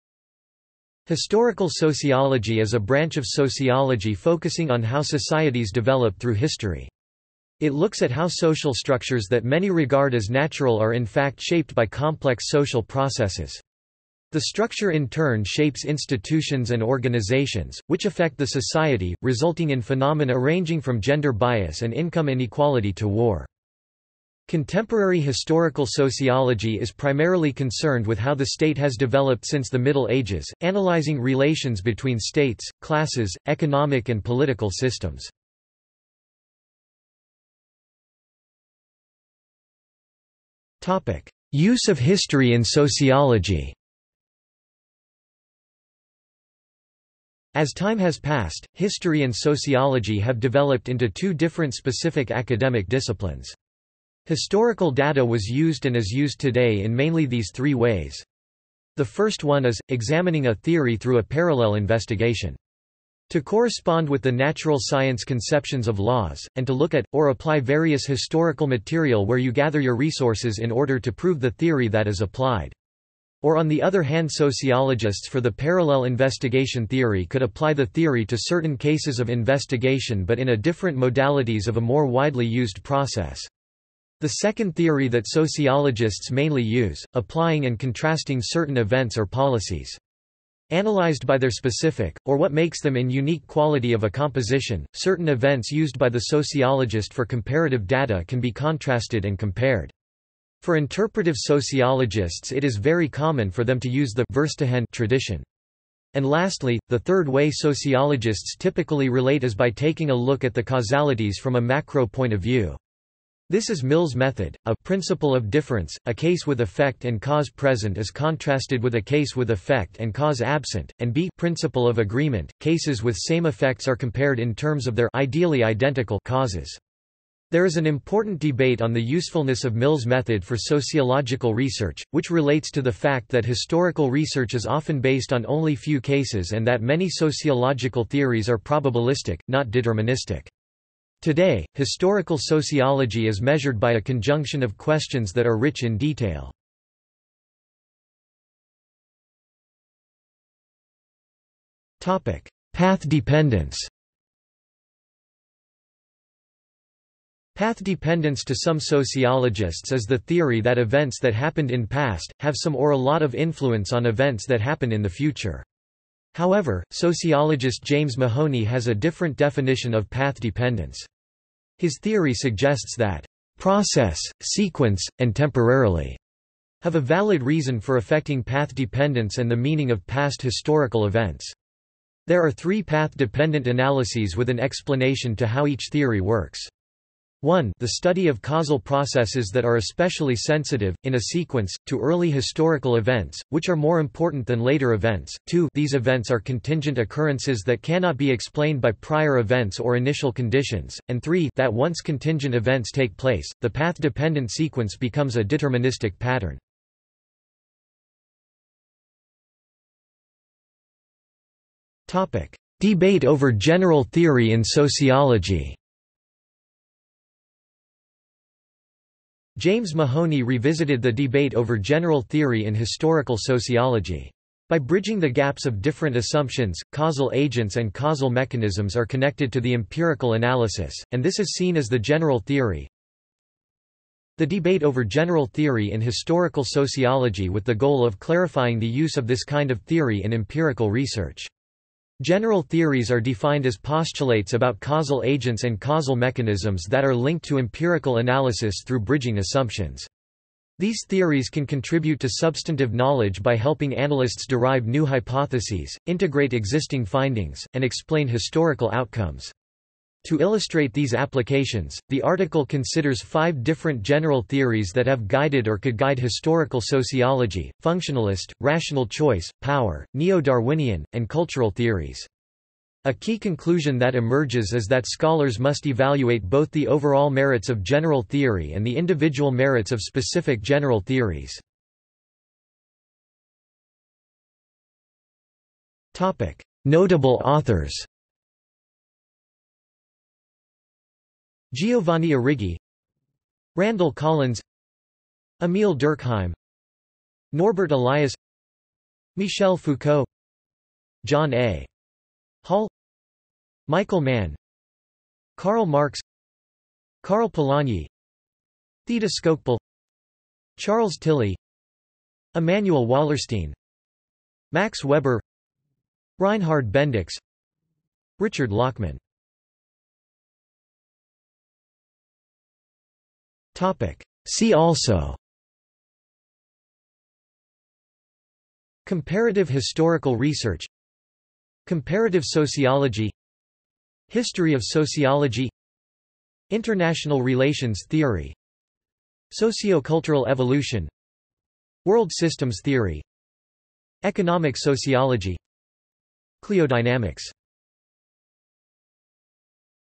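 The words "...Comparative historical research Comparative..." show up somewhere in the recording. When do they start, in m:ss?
5:29.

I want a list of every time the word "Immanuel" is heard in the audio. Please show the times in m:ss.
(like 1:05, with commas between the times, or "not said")
5:12.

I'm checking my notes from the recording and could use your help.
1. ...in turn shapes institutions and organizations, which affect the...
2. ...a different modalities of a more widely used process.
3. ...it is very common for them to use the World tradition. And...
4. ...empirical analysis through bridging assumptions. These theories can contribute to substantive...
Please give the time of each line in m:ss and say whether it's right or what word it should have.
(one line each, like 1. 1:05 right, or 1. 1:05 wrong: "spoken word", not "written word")
1. 0:14 right
2. 1:20 right
3. 1:42 wrong: "Verstehen", not "World"
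4. 4:07 right.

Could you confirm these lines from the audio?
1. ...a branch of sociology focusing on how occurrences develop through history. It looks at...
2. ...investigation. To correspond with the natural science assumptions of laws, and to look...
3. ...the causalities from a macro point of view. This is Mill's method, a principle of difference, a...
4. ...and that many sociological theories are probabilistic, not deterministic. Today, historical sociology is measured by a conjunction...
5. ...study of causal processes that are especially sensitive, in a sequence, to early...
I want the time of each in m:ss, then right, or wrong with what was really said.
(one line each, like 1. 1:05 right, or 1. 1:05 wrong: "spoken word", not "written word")
1. 0:02 wrong: "societies", not "occurrences"
2. 1:01 wrong: "conceptions", not "assumptions"
3. 1:50 right
4. 2:16 right
5. 3:07 right.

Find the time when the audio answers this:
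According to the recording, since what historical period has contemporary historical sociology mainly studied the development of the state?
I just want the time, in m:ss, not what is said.
0:29.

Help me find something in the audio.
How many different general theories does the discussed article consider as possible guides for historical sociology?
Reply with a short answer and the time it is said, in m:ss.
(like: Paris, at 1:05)
5, at 4:23.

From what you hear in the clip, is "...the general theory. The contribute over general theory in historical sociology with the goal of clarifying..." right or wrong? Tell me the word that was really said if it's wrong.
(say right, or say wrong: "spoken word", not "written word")
wrong: "debate", not "contribute".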